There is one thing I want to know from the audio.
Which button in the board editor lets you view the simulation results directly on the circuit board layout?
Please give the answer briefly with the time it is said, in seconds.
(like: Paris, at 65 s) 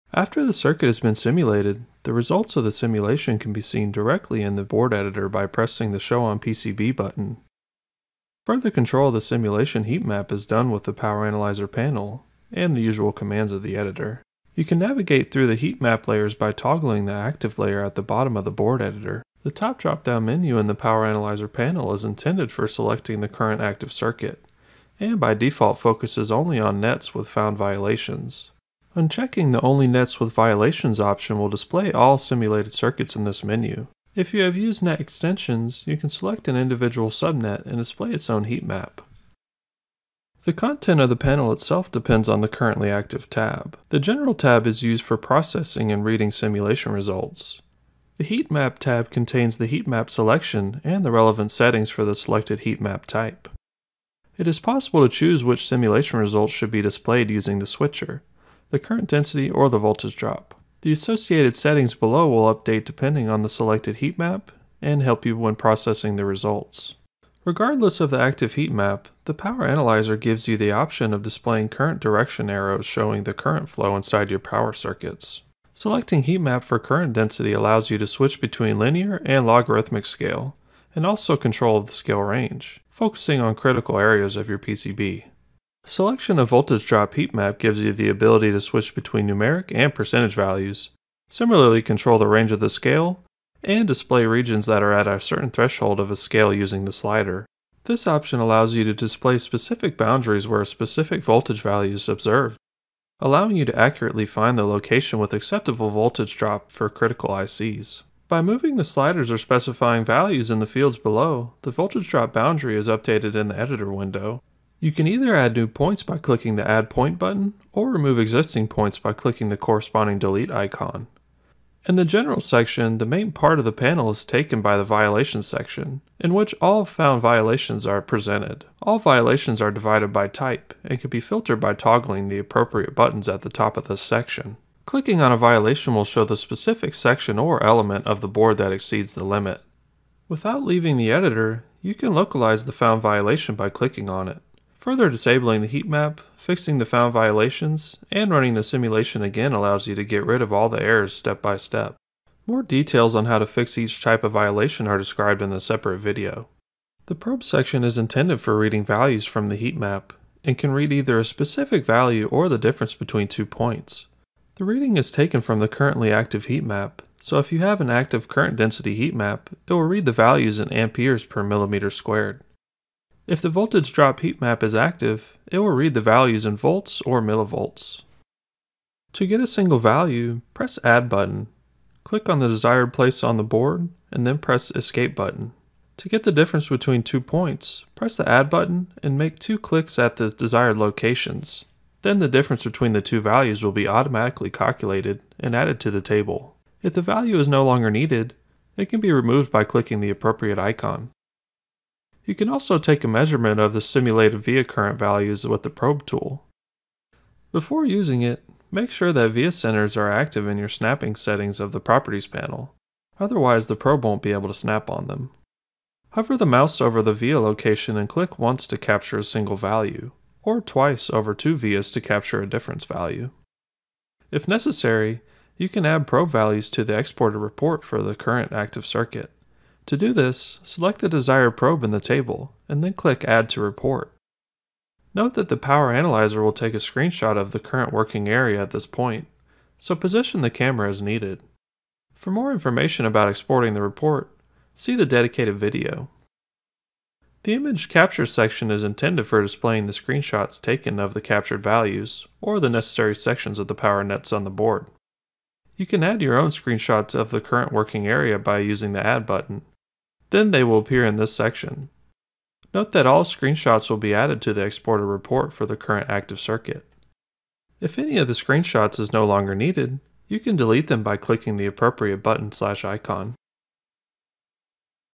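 Show on PCB, at 6 s.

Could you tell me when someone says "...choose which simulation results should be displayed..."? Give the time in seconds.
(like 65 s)
55 s.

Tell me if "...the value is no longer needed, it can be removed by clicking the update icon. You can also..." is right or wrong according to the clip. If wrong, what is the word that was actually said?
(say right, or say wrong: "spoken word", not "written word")
wrong: "appropriate", not "update".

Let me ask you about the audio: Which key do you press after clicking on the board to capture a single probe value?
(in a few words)
Escape.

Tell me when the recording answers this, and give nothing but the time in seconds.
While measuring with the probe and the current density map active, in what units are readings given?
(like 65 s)
170 s.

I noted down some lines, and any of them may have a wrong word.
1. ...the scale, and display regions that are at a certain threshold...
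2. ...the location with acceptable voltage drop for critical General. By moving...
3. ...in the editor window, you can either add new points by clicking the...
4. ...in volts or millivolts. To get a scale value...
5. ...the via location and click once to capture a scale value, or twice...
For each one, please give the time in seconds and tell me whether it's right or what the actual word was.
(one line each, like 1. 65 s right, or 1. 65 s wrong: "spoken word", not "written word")
1. 92 s right
2. 104 s wrong: "ICs", not "General"
3. 113 s right
4. 176 s wrong: "single", not "scale"
5. 217 s wrong: "single", not "scale".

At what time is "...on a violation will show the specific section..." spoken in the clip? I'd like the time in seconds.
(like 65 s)
135 s.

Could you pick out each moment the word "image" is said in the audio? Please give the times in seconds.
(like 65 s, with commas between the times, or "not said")
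247 s.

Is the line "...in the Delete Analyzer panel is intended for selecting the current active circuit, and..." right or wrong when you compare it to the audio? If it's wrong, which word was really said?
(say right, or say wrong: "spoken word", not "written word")
wrong: "Power", not "Delete".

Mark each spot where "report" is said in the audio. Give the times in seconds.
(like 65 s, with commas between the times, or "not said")
227 s, 233 s, 243 s, 265 s.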